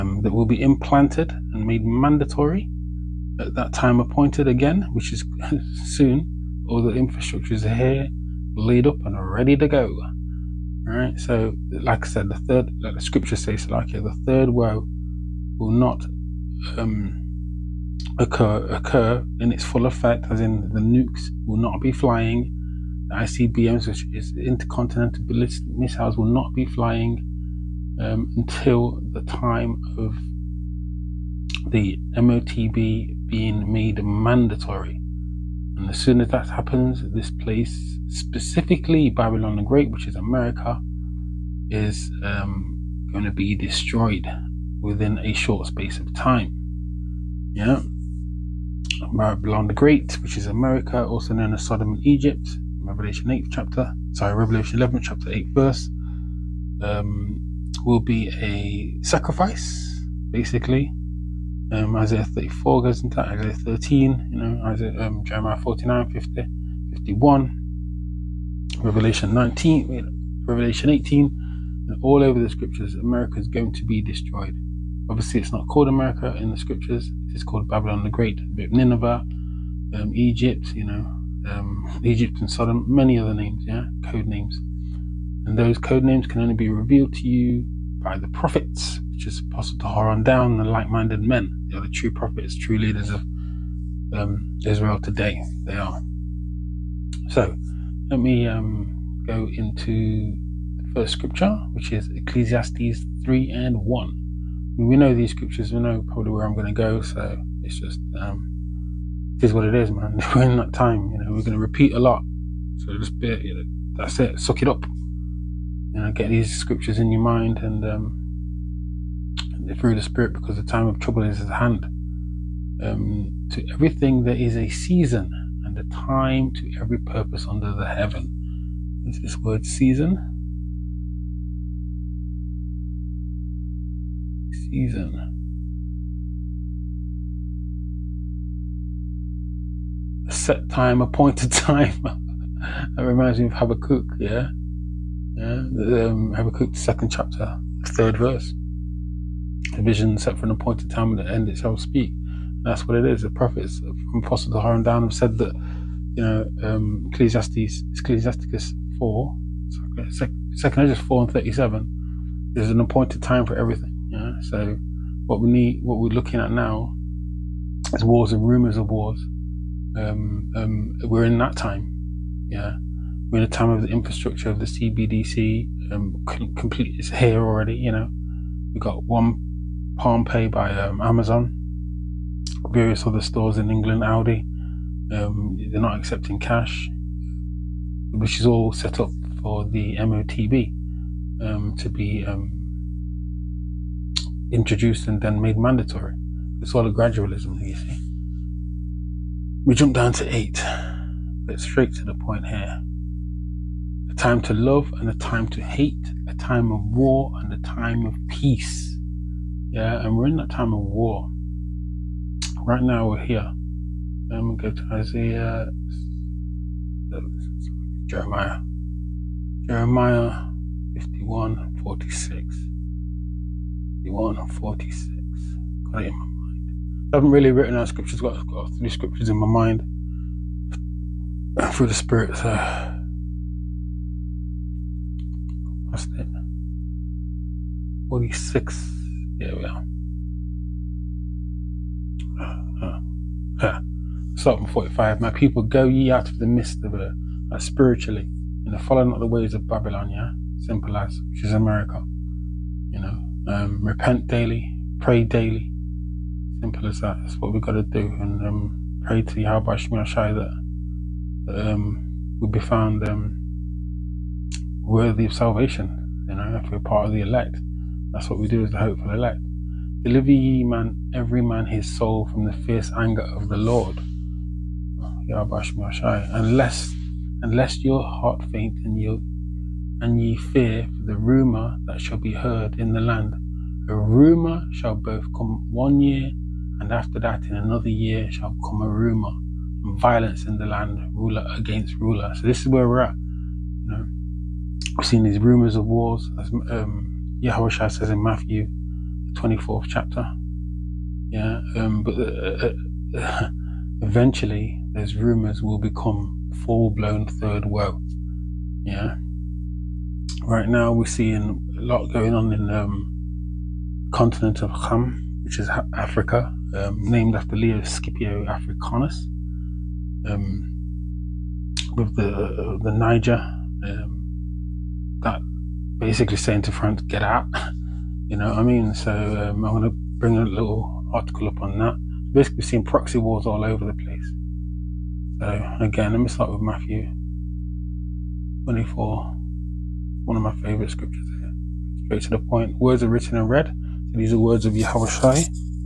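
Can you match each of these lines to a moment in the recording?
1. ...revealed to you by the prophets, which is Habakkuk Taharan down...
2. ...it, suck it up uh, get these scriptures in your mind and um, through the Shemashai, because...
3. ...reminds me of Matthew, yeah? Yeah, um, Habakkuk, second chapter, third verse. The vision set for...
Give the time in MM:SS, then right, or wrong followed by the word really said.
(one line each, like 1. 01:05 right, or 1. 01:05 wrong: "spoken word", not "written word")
1. 01:26 wrong: "Apostle", not "Habakkuk"
2. 01:54 wrong: "Spirit", not "Shemashai"
3. 02:22 wrong: "Habakkuk", not "Matthew".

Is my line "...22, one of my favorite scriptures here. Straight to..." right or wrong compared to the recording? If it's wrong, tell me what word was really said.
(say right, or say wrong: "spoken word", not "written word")
wrong: "24", not "22".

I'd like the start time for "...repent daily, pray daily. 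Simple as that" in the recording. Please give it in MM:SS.
04:13.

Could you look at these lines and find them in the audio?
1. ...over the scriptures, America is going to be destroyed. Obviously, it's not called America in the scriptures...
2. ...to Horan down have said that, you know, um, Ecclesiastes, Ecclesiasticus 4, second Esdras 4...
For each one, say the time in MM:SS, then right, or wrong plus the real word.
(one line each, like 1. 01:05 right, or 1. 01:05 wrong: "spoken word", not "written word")
1. 01:12 right
2. 02:34 right.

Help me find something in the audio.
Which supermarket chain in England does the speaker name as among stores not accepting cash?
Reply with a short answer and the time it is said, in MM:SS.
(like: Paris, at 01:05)
Aldi, at 03:04.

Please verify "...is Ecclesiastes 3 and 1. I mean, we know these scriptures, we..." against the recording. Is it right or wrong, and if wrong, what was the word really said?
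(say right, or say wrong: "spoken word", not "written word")
right.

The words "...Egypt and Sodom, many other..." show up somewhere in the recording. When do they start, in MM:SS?
01:22.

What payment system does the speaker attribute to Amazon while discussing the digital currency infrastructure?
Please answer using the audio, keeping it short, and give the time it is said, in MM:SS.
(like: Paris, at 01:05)
Palm Pay, at 02:59.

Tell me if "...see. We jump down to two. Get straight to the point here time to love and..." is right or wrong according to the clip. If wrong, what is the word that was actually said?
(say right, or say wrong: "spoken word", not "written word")
wrong: "eight", not "two".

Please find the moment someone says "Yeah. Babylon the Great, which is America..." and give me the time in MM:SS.
00:47.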